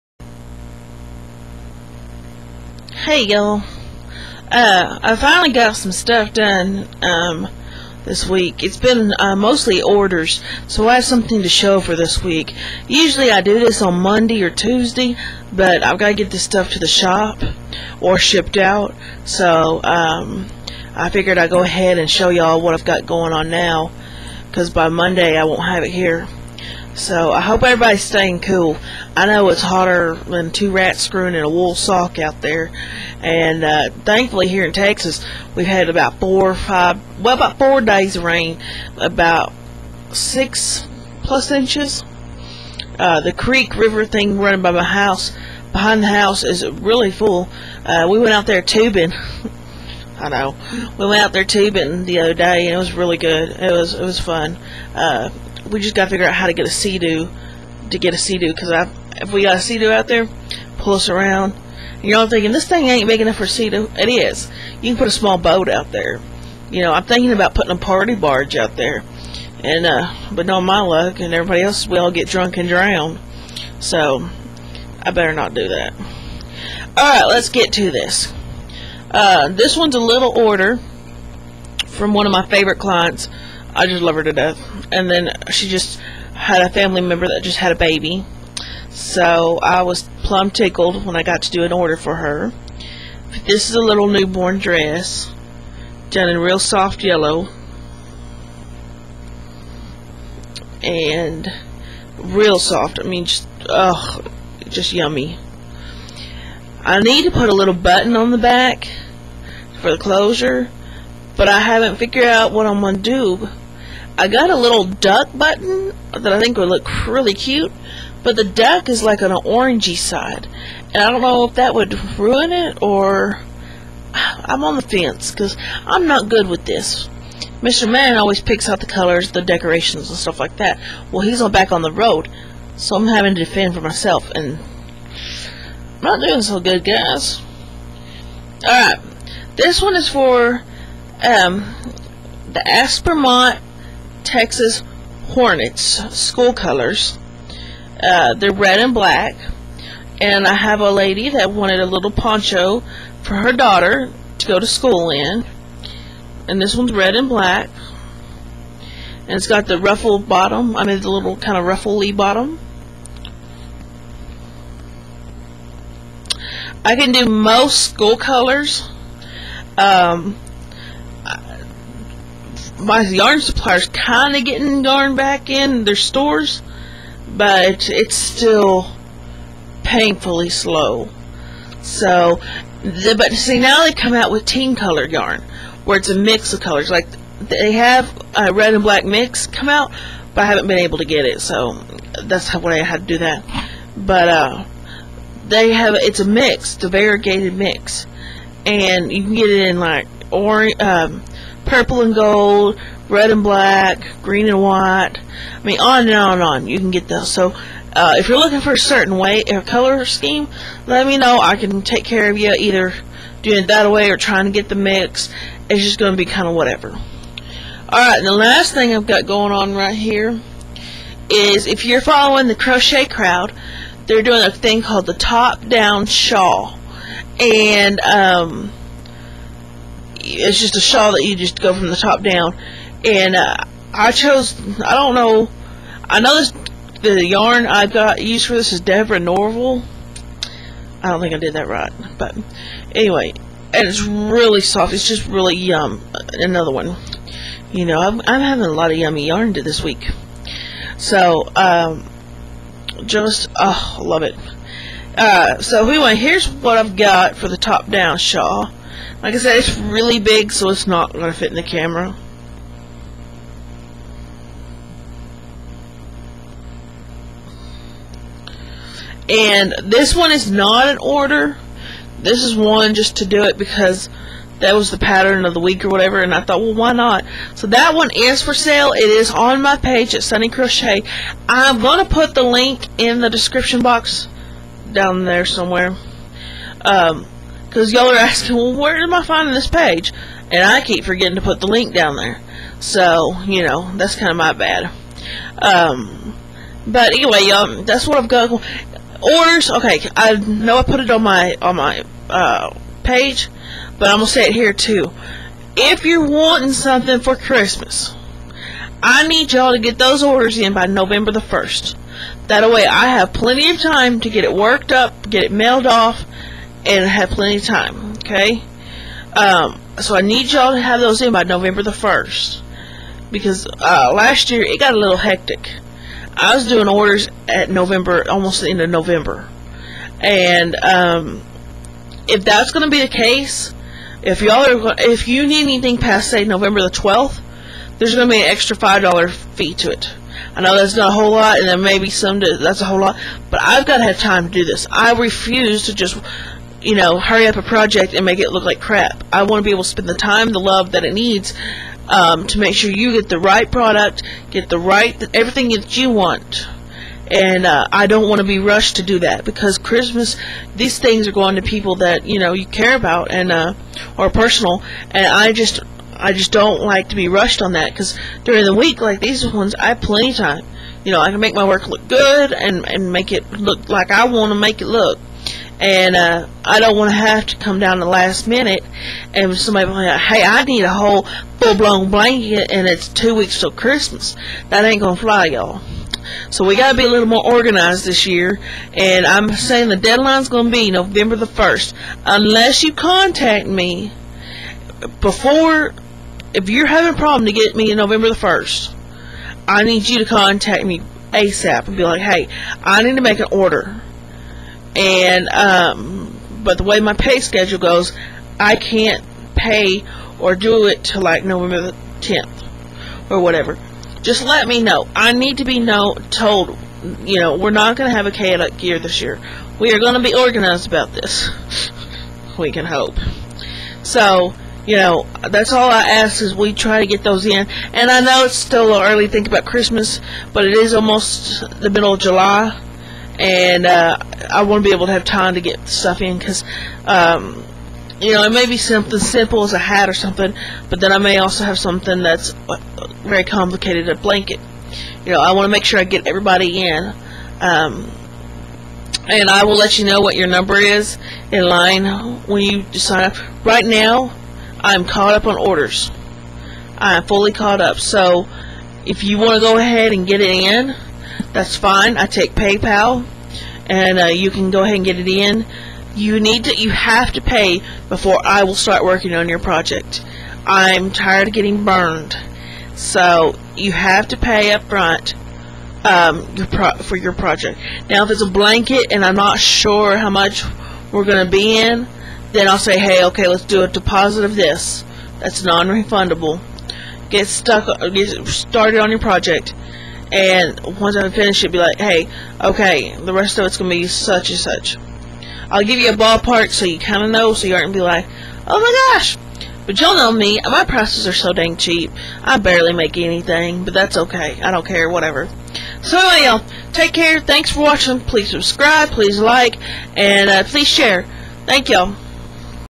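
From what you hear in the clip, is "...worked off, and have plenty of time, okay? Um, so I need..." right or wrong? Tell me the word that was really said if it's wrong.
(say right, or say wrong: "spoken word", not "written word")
wrong: "mailed", not "worked".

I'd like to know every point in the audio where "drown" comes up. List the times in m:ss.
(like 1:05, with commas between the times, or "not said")
1:12.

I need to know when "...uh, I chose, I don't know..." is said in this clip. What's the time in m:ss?
3:53.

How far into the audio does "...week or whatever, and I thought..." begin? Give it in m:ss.
4:35.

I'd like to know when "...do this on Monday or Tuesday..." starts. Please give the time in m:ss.
0:13.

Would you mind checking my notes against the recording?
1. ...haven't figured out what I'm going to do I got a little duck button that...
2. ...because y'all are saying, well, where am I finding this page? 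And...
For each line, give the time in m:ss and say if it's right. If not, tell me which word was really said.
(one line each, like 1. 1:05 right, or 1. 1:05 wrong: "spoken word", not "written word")
1. 1:51 right
2. 4:47 wrong: "asking", not "saying".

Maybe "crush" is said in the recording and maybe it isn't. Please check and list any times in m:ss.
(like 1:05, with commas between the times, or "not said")
not said.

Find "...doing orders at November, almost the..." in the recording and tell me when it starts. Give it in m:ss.
5:26.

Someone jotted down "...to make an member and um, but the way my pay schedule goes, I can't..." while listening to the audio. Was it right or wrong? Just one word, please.
wrong.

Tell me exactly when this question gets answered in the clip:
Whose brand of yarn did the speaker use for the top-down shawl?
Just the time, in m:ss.
3:58.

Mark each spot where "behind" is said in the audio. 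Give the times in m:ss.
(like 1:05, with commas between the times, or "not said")
0:45.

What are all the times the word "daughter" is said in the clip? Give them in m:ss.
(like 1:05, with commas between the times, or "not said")
2:33.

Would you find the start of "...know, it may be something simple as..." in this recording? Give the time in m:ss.
7:18.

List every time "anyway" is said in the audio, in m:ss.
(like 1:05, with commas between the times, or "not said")
4:02, 4:15, 4:57, 8:26.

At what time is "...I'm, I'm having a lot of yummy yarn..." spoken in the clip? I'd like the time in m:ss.
4:07.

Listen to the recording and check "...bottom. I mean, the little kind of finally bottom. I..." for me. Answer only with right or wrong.
wrong.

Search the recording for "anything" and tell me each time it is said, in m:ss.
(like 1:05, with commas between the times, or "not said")
5:35, 8:23.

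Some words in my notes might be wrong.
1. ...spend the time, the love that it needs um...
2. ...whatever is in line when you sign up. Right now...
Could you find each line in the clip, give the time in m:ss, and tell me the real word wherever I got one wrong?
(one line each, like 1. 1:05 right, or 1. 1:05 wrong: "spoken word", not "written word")
1. 5:49 right
2. 7:30 wrong: "number", not "whatever".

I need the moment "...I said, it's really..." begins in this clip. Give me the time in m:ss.
4:19.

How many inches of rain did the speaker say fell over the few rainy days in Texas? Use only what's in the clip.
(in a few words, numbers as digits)
6.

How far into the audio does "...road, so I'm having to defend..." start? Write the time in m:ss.
2:11.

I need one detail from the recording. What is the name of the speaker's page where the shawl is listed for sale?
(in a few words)
Sunny Crochet.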